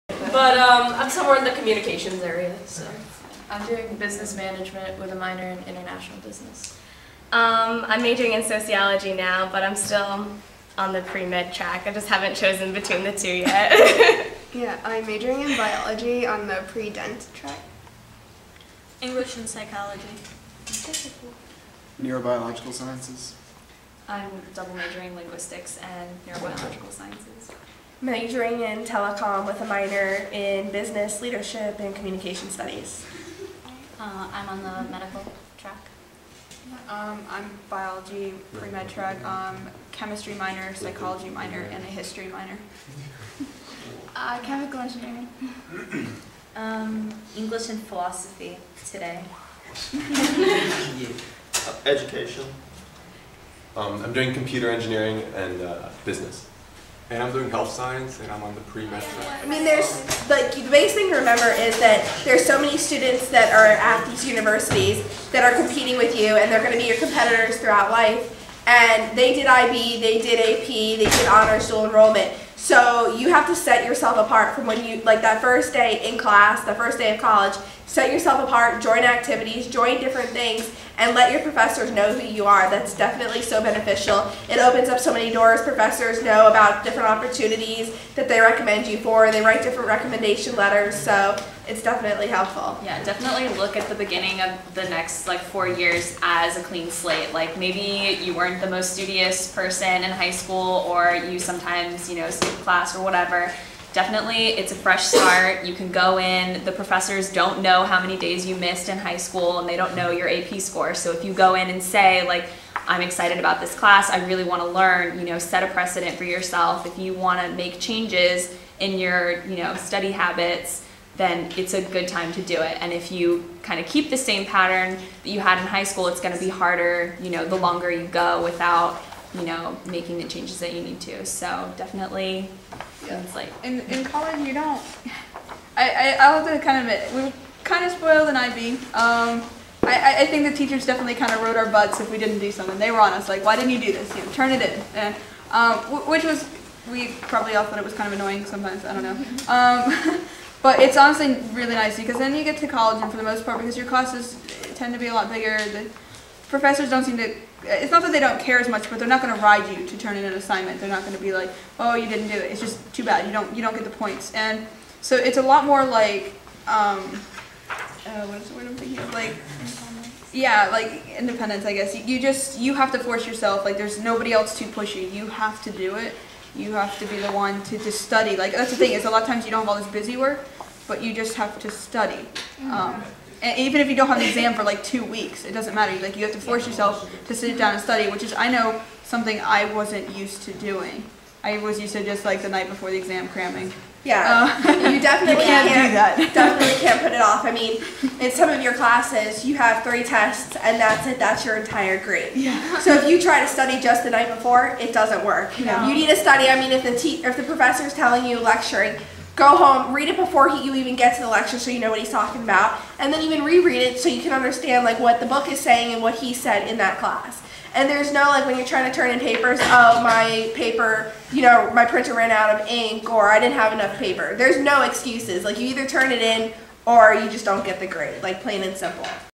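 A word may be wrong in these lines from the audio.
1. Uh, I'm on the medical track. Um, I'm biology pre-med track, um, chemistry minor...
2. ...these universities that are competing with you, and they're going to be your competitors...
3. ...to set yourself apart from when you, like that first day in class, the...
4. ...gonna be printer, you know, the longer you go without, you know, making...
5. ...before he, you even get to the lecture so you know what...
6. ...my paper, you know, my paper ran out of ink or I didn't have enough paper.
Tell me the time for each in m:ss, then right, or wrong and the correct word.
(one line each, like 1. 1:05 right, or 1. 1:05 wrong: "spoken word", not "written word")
1. 0:33 right
2. 1:04 right
3. 1:13 right
4. 2:06 wrong: "harder", not "printer"
5. 3:30 right
6. 3:40 wrong: "printer", not "paper".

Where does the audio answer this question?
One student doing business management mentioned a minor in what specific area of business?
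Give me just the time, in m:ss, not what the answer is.
0:05.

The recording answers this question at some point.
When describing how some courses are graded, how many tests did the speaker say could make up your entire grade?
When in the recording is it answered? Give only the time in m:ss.
3:19.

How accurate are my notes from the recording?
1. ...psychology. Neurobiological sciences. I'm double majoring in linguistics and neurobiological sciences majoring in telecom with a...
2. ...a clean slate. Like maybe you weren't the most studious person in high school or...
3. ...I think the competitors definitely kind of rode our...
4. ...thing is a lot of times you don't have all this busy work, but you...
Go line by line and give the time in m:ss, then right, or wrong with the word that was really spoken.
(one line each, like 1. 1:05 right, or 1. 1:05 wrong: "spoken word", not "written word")
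1. 0:19 right
2. 1:36 right
3. 2:20 wrong: "teachers", not "competitors"
4. 2:58 right.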